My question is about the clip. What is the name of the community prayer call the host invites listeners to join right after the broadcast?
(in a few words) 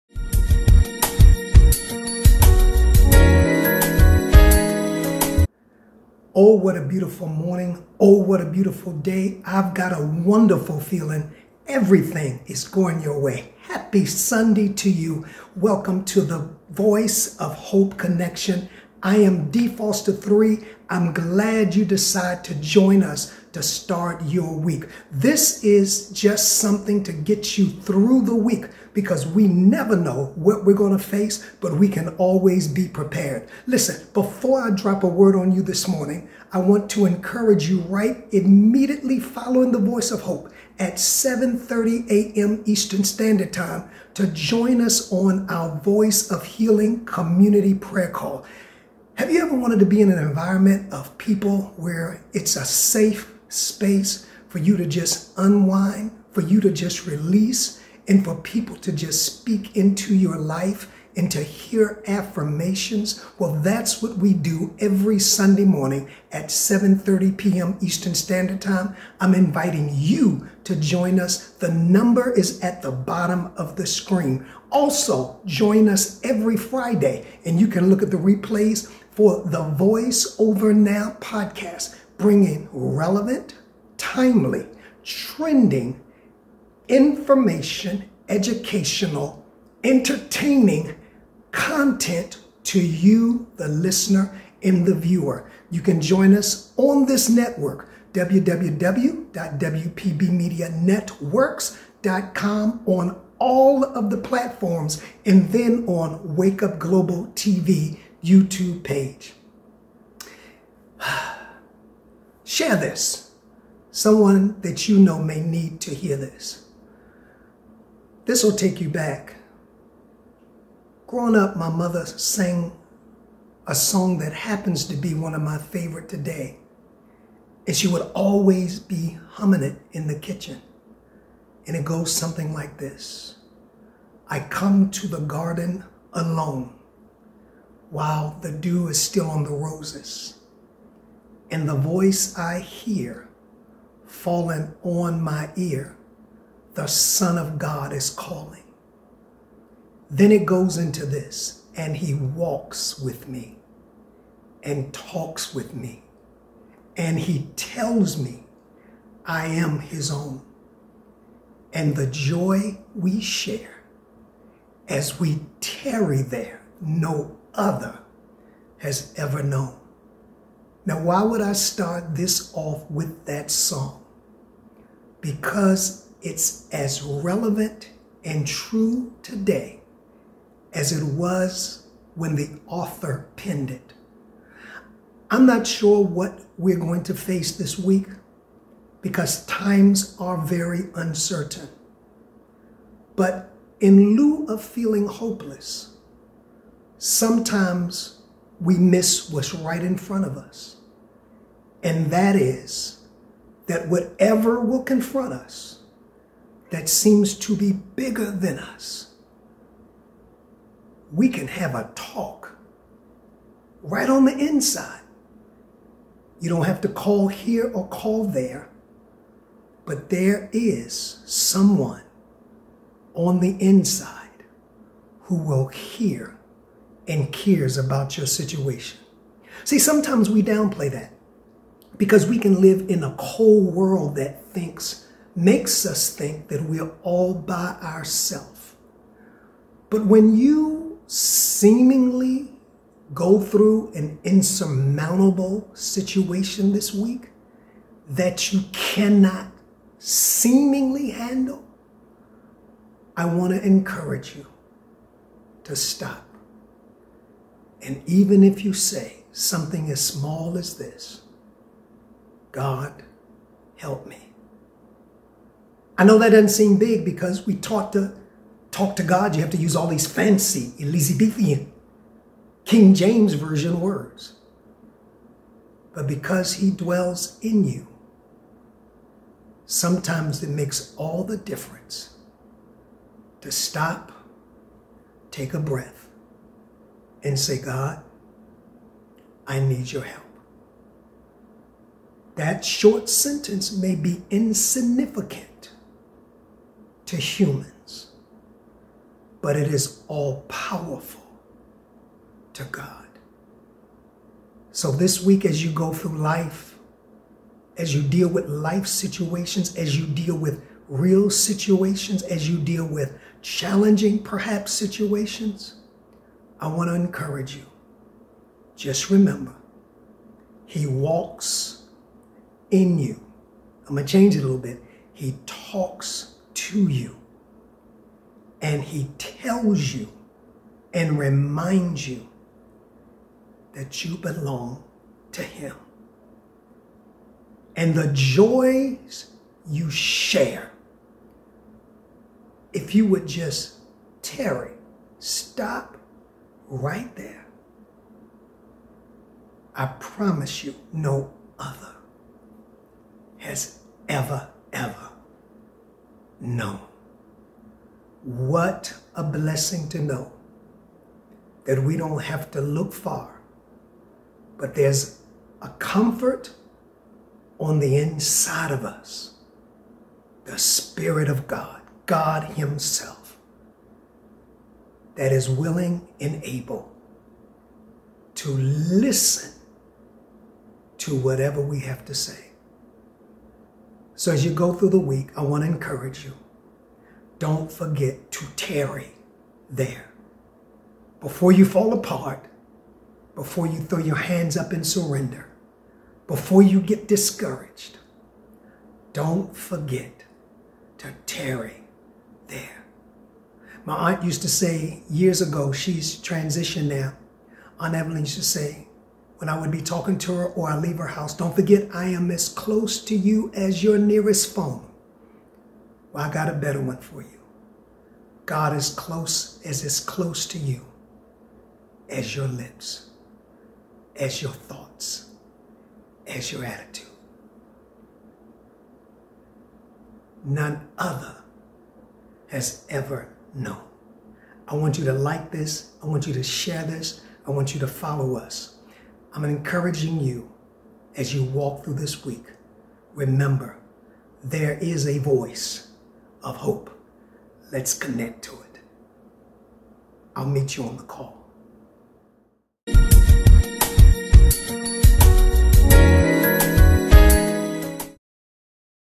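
Voice of Healing.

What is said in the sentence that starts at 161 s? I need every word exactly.
And the joy we share as we tarry there, no other has ever known.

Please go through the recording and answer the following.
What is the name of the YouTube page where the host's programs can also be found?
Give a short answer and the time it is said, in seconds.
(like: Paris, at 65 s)
Wake Up Global TV, at 106 s.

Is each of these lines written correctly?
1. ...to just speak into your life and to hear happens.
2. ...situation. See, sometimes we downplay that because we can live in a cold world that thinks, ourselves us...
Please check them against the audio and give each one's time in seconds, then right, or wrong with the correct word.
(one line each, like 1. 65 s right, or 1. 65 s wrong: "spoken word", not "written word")
1. 58 s wrong: "affirmations", not "happens"
2. 228 s wrong: "makes", not "ourselves".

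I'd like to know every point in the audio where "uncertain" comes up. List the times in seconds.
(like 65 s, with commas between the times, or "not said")
190 s.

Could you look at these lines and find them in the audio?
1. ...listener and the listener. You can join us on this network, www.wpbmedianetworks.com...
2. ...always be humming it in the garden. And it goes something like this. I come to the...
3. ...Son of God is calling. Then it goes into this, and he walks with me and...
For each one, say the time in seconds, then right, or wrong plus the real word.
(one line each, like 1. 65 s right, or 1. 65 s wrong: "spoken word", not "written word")
1. 93 s wrong: "viewer", not "listener"
2. 128 s wrong: "kitchen", not "garden"
3. 146 s right.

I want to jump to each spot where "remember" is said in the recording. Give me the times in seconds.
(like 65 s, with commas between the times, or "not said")
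319 s, 443 s.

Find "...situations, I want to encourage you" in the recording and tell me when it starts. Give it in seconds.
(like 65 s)
314 s.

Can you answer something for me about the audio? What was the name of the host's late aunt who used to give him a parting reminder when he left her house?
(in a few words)
Evelyn.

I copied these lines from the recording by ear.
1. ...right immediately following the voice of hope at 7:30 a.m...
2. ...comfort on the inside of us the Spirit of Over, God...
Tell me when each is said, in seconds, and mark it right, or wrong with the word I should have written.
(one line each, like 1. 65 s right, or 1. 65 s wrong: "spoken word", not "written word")
1. 37 s right
2. 365 s wrong: "God", not "Over".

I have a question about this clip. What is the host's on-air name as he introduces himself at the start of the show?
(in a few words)
D Foster 3.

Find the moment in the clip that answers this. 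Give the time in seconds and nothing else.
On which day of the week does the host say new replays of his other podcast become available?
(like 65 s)
76 s.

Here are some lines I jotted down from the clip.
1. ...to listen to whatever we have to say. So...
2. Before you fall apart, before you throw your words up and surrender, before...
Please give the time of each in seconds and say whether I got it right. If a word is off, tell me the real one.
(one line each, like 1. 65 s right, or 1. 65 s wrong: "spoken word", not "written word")
1. 378 s right
2. 391 s wrong: "hands", not "words".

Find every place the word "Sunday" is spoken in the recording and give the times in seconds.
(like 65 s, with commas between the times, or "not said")
14 s, 65 s.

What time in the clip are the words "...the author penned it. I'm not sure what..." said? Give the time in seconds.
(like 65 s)
182 s.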